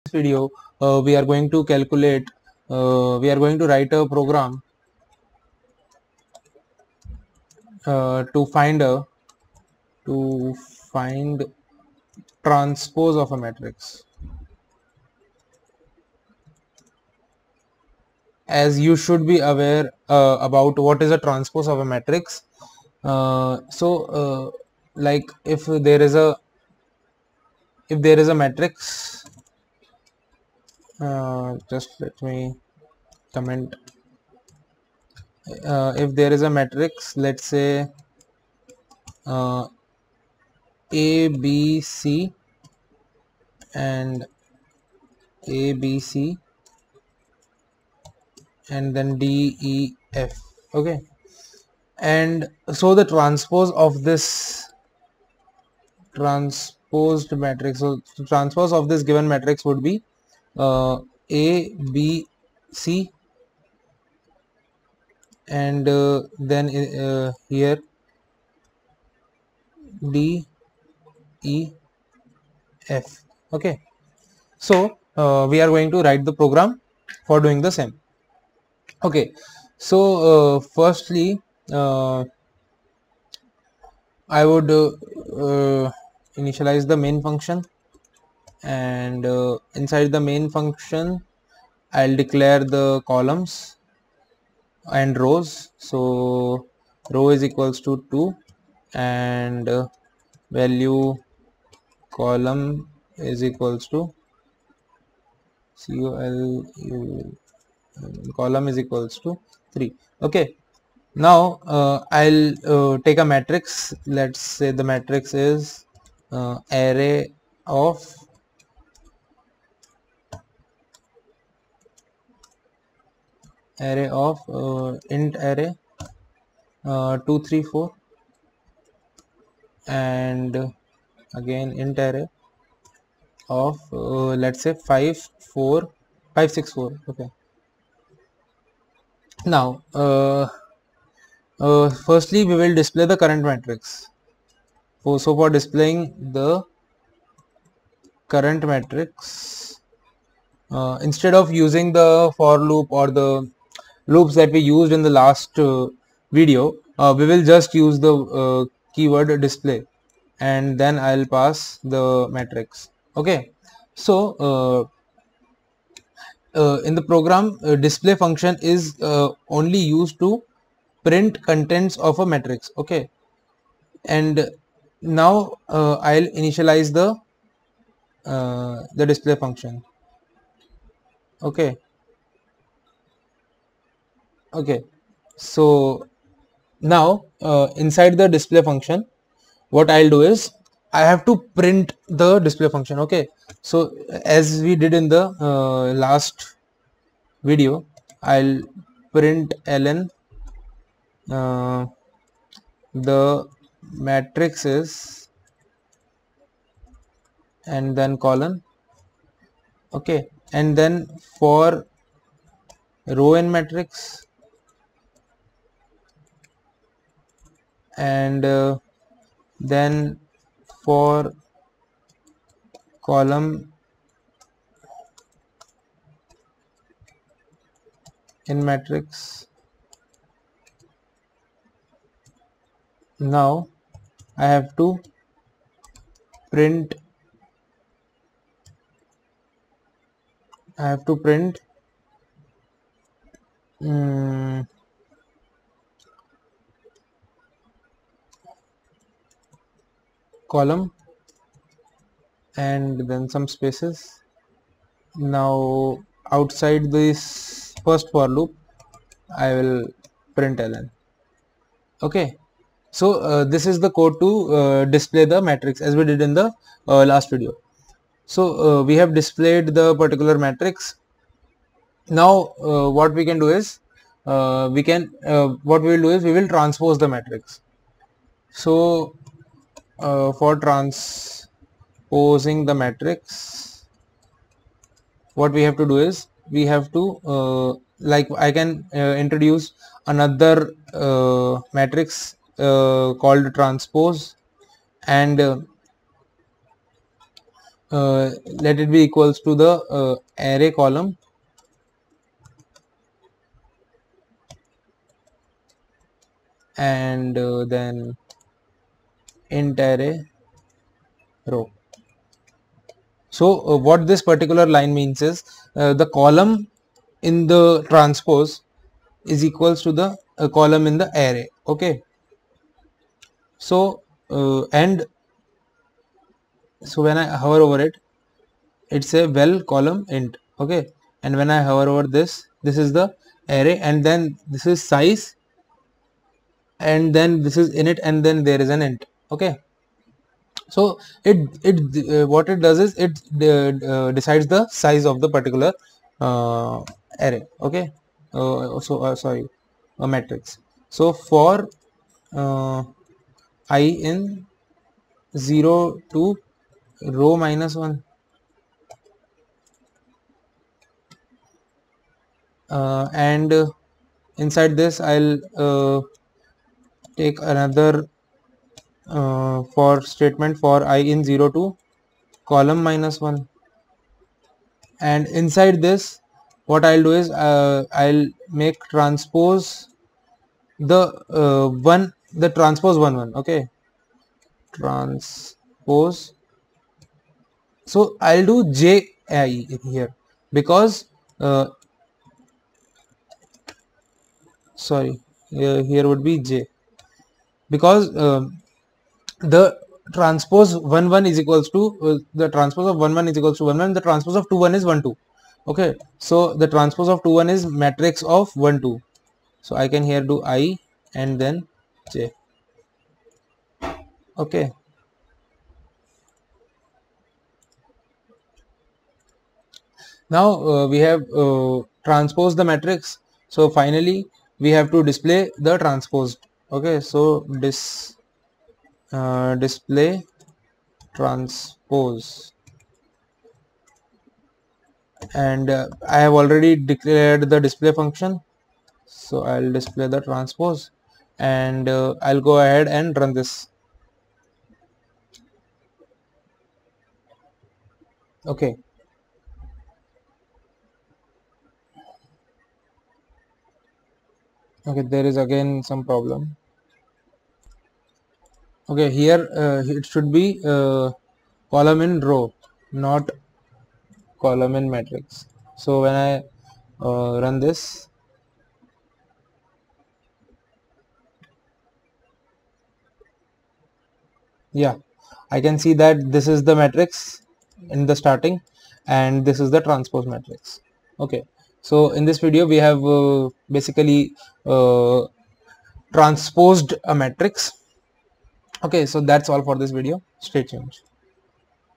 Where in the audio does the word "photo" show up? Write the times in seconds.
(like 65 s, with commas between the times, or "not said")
not said.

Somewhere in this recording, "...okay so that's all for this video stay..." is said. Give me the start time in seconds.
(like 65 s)
488 s.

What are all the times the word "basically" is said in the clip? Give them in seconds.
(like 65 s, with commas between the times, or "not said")
483 s.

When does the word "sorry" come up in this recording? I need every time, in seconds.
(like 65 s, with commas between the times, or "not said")
349 s, 394 s.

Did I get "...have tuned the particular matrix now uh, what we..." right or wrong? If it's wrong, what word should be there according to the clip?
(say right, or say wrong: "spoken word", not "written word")
wrong: "displayed", not "tuned".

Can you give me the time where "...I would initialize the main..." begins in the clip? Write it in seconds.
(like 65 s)
84 s.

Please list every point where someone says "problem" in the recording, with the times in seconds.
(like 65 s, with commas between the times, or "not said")
456 s.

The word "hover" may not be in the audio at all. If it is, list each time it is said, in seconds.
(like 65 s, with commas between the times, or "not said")
327 s, 331 s.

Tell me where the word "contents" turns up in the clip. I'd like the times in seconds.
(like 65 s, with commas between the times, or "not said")
171 s.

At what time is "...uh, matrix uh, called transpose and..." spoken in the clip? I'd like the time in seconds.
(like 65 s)
290 s.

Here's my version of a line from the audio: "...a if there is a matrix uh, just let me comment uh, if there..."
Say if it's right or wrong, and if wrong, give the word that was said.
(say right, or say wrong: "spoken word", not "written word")
right.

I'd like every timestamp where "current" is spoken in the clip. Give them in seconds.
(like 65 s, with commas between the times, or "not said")
143 s, 148 s.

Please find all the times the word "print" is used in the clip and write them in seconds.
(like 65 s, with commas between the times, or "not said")
171 s, 191 s, 199 s, 236 s, 241 s, 260 s.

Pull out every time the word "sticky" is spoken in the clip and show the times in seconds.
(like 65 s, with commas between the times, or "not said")
not said.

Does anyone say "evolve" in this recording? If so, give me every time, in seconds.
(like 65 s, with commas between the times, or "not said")
not said.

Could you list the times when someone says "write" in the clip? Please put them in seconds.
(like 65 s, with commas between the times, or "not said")
3 s, 76 s.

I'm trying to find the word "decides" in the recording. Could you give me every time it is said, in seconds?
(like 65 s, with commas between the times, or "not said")
344 s.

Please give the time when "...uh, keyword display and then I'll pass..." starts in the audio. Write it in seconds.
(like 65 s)
158 s.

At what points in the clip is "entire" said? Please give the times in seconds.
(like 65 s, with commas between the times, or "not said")
309 s.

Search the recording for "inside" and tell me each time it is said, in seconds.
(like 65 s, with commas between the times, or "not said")
89 s, 187 s, 364 s, 375 s.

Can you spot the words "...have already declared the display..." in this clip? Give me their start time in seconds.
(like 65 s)
436 s.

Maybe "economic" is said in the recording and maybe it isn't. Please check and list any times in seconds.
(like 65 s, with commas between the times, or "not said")
not said.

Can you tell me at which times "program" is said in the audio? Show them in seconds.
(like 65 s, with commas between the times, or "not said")
4 s, 76 s, 167 s.